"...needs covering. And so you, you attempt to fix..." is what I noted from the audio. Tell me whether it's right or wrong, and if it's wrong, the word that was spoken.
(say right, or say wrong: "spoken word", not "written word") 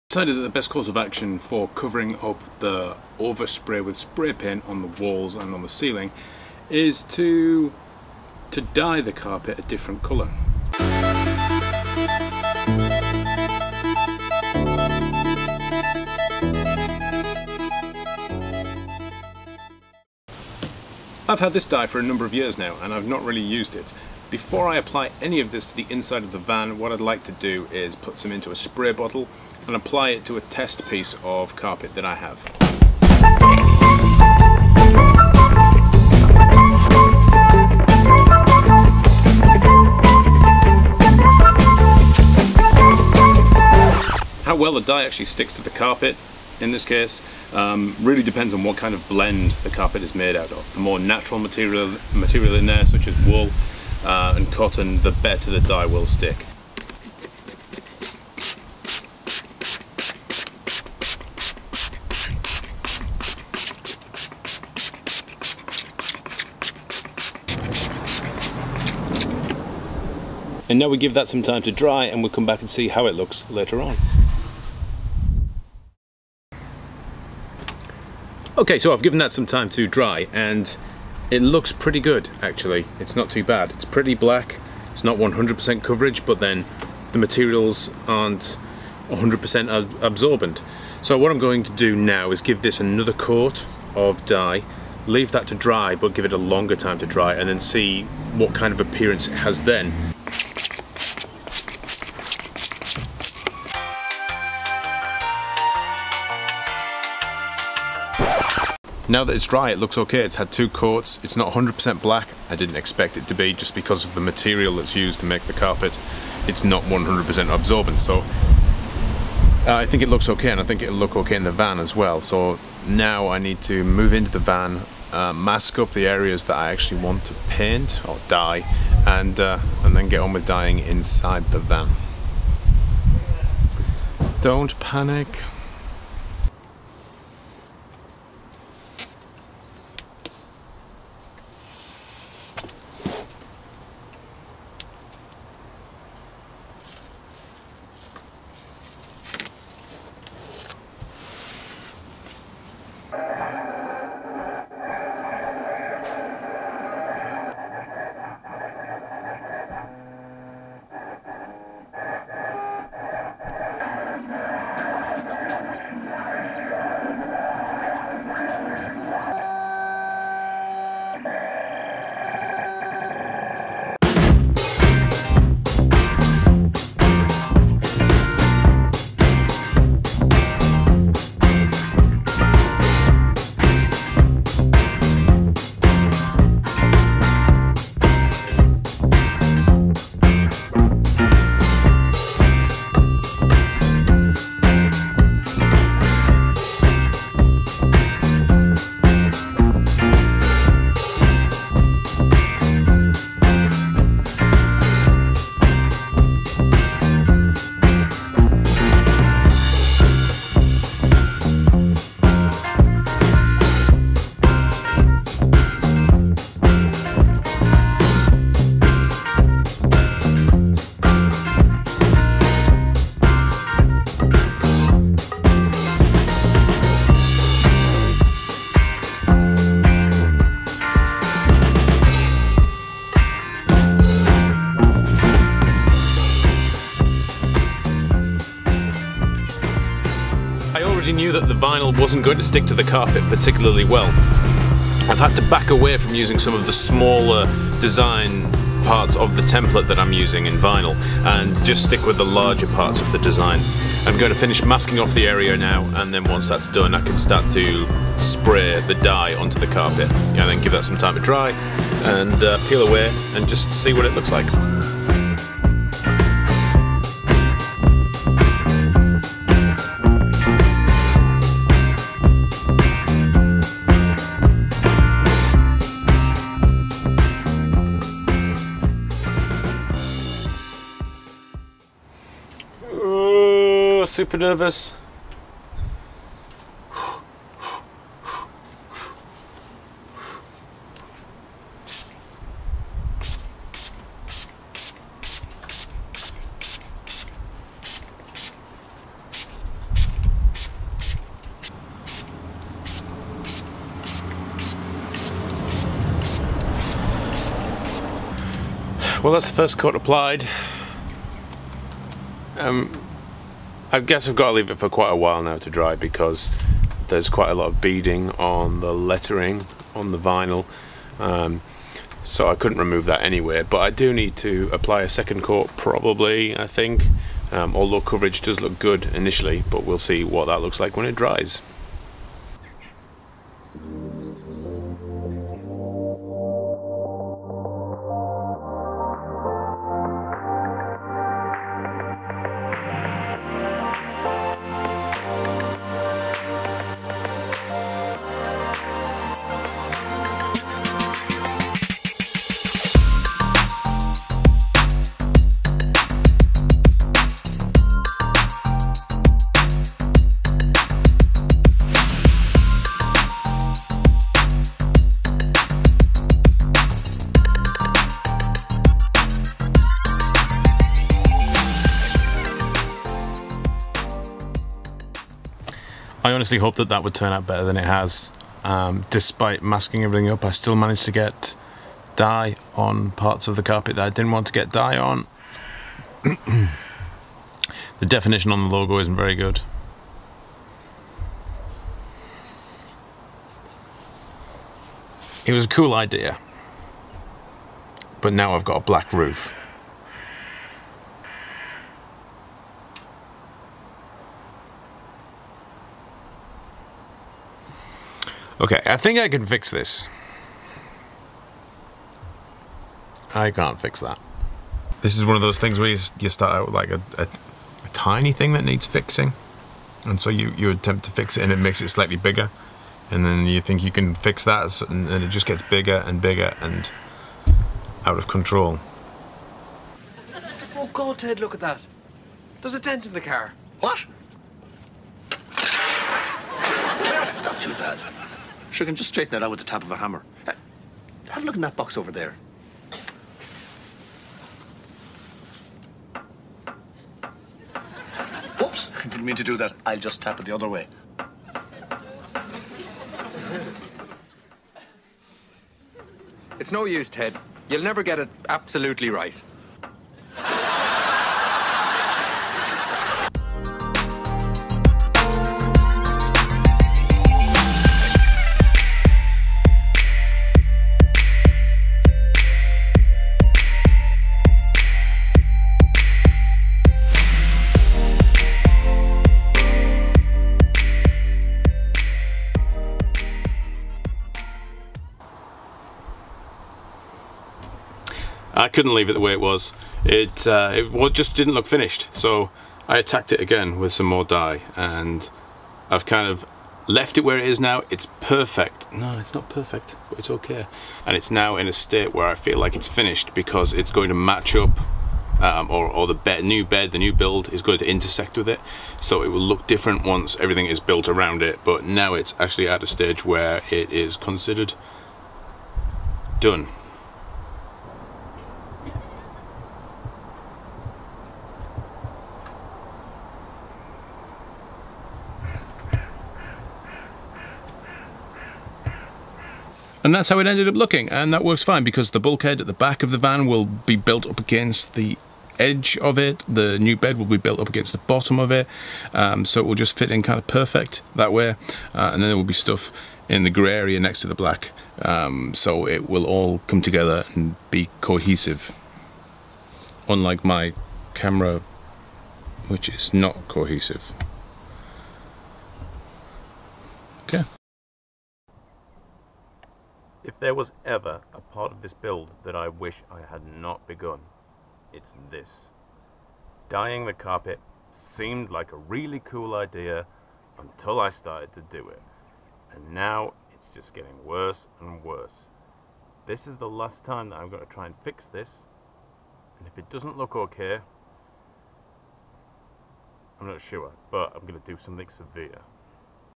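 wrong: "fixing", not "covering".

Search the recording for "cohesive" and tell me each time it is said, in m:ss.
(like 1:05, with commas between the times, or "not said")
9:08, 9:13.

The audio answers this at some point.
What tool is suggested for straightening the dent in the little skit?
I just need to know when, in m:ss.
7:19.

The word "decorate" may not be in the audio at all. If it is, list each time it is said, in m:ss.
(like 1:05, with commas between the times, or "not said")
not said.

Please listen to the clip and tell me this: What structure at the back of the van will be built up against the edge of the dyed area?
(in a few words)
The bulkhead.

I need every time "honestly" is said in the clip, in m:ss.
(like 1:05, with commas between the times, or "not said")
6:16.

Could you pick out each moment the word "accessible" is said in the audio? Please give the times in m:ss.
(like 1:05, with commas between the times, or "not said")
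not said.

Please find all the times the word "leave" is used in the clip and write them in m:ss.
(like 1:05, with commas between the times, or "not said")
1:35, 5:14, 8:08.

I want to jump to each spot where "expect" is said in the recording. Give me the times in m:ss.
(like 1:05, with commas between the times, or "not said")
1:52.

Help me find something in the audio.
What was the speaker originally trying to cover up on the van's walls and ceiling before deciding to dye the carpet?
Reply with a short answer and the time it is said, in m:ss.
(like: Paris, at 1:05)
Overspray, at 0:03.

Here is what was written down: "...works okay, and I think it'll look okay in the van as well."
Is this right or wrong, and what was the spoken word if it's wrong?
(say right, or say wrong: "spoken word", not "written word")
wrong: "looks", not "works".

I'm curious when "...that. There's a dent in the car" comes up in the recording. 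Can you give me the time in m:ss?
7:11.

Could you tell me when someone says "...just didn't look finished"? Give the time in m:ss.
8:11.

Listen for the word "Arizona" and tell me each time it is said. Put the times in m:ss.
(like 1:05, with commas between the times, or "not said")
not said.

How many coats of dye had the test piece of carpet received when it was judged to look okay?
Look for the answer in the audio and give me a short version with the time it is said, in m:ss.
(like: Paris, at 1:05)
2, at 1:50.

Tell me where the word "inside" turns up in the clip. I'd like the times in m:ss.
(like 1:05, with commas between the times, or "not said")
0:25, 2:10.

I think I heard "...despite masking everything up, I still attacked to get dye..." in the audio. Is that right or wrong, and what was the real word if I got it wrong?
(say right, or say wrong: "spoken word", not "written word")
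wrong: "managed", not "attacked".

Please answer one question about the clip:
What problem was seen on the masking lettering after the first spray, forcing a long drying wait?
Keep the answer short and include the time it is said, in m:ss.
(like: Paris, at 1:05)
Beading, at 5:17.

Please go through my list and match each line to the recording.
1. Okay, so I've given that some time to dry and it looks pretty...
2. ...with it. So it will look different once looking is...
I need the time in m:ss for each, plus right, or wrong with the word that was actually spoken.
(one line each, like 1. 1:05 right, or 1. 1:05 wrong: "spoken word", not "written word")
1. 1:18 right
2. 8:28 wrong: "everything", not "looking".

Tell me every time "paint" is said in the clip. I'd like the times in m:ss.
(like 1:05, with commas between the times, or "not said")
0:04, 2:07.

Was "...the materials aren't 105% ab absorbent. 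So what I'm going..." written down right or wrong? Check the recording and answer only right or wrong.
wrong.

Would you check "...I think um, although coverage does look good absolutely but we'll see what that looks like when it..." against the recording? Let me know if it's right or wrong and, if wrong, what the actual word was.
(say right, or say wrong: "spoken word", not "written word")
wrong: "initially", not "absolutely".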